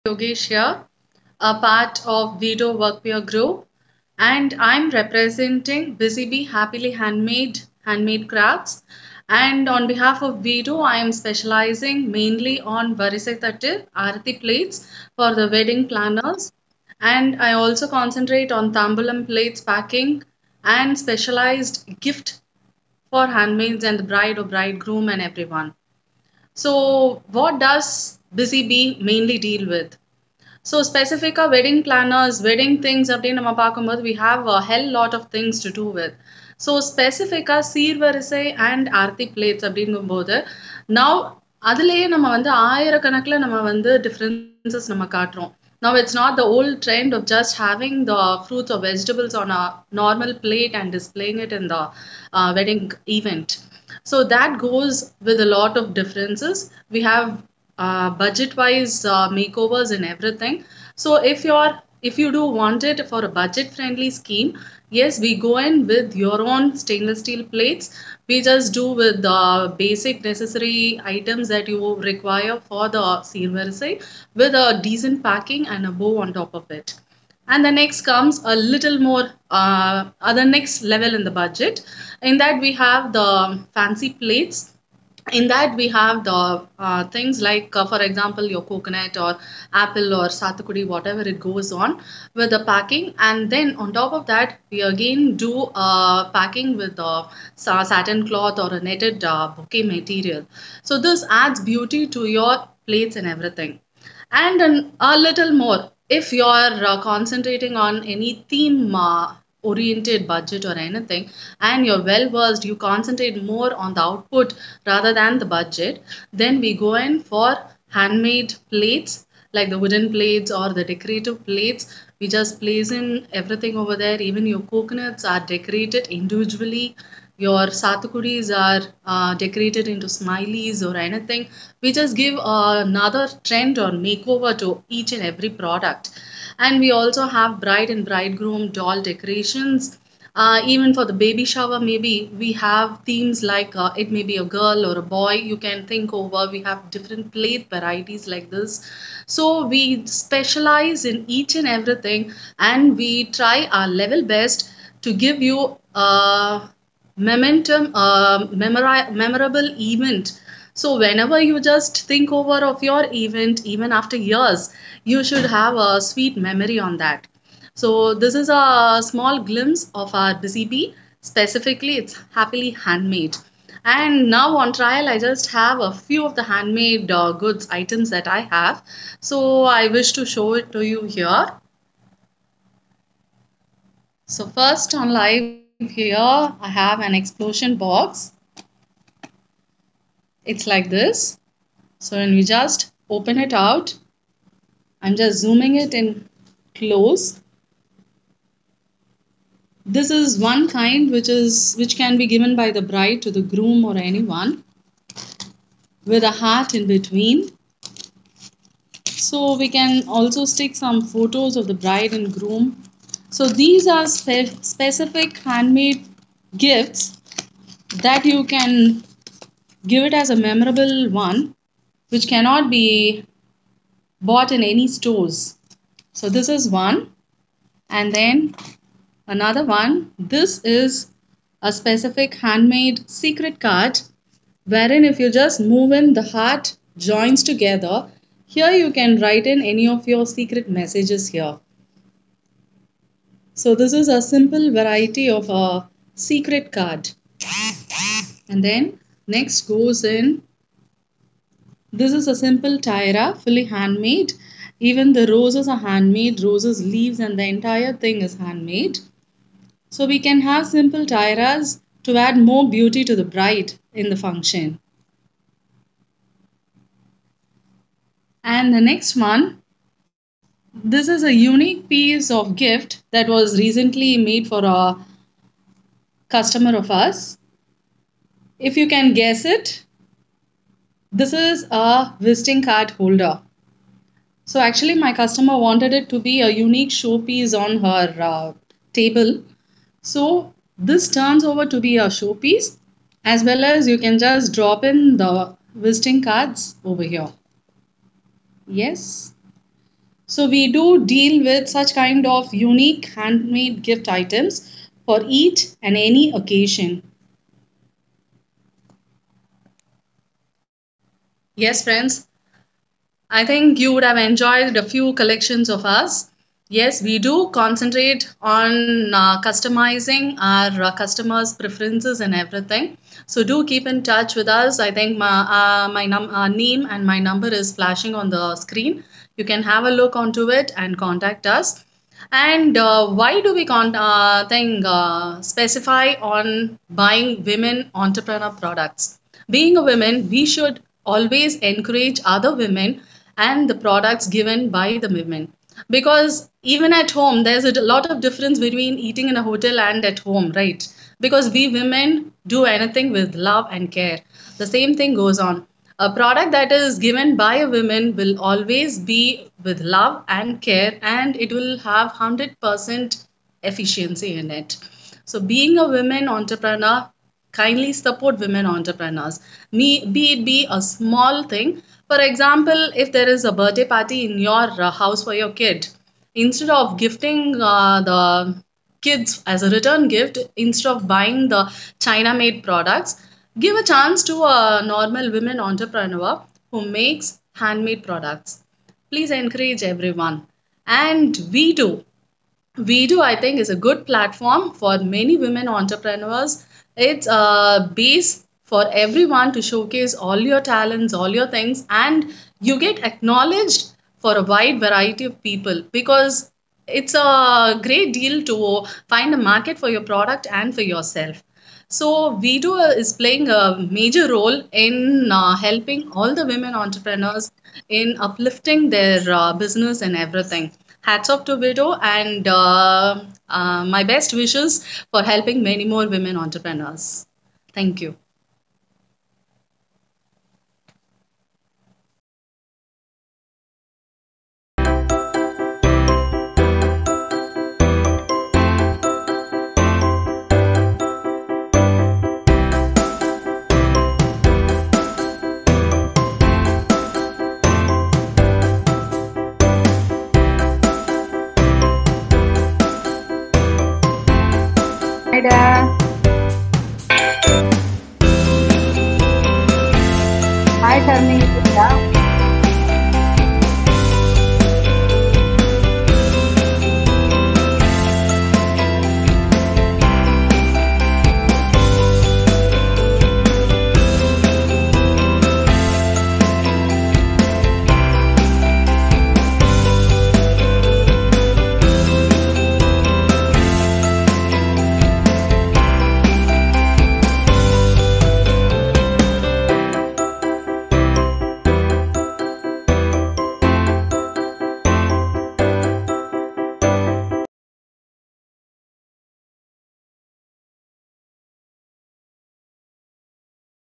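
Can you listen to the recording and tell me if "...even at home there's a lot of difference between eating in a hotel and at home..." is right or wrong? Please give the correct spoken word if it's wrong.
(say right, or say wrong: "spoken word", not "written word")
right.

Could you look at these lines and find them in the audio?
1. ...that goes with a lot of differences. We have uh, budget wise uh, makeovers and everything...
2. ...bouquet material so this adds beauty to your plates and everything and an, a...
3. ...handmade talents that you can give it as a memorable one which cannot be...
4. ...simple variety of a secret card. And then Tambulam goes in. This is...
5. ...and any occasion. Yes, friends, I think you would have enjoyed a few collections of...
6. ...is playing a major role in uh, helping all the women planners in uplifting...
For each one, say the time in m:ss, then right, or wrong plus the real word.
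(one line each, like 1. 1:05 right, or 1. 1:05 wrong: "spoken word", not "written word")
1. 0:54 right
2. 1:39 right
3. 3:35 wrong: "gifts", not "talents"
4. 4:04 wrong: "Next", not "Tambulam"
5. 5:05 right
6. 6:52 wrong: "entrepreneurs", not "planners".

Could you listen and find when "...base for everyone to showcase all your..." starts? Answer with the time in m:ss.
6:37.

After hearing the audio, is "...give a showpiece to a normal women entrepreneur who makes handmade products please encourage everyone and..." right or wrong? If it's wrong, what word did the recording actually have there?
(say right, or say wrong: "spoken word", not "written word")
wrong: "chance", not "showpiece".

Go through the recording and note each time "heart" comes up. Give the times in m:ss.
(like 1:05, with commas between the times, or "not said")
3:26, 3:56.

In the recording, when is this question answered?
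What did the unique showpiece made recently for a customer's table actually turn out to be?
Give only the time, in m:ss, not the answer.
4:42.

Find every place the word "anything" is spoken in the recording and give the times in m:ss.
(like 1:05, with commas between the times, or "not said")
1:50, 2:10, 5:52.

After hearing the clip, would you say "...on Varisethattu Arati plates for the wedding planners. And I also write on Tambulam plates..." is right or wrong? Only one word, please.
wrong.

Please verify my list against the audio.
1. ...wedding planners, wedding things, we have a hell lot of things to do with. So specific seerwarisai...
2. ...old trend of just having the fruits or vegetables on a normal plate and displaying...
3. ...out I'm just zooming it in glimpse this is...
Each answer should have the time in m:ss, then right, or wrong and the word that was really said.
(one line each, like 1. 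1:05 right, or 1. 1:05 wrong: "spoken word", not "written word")
1. 0:31 right
2. 0:46 right
3. 3:13 wrong: "close", not "glimpse".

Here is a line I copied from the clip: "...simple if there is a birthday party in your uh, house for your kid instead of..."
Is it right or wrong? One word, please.
wrong.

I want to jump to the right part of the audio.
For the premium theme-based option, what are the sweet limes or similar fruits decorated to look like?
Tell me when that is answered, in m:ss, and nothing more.
2:10.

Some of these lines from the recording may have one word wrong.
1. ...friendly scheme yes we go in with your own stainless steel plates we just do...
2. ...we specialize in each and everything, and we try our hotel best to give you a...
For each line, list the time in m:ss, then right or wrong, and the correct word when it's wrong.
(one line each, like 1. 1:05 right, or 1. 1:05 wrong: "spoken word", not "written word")
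1. 1:03 right
2. 2:29 wrong: "level", not "hotel".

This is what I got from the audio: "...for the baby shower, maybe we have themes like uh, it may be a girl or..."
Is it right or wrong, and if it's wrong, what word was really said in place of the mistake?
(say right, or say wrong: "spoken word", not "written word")
right.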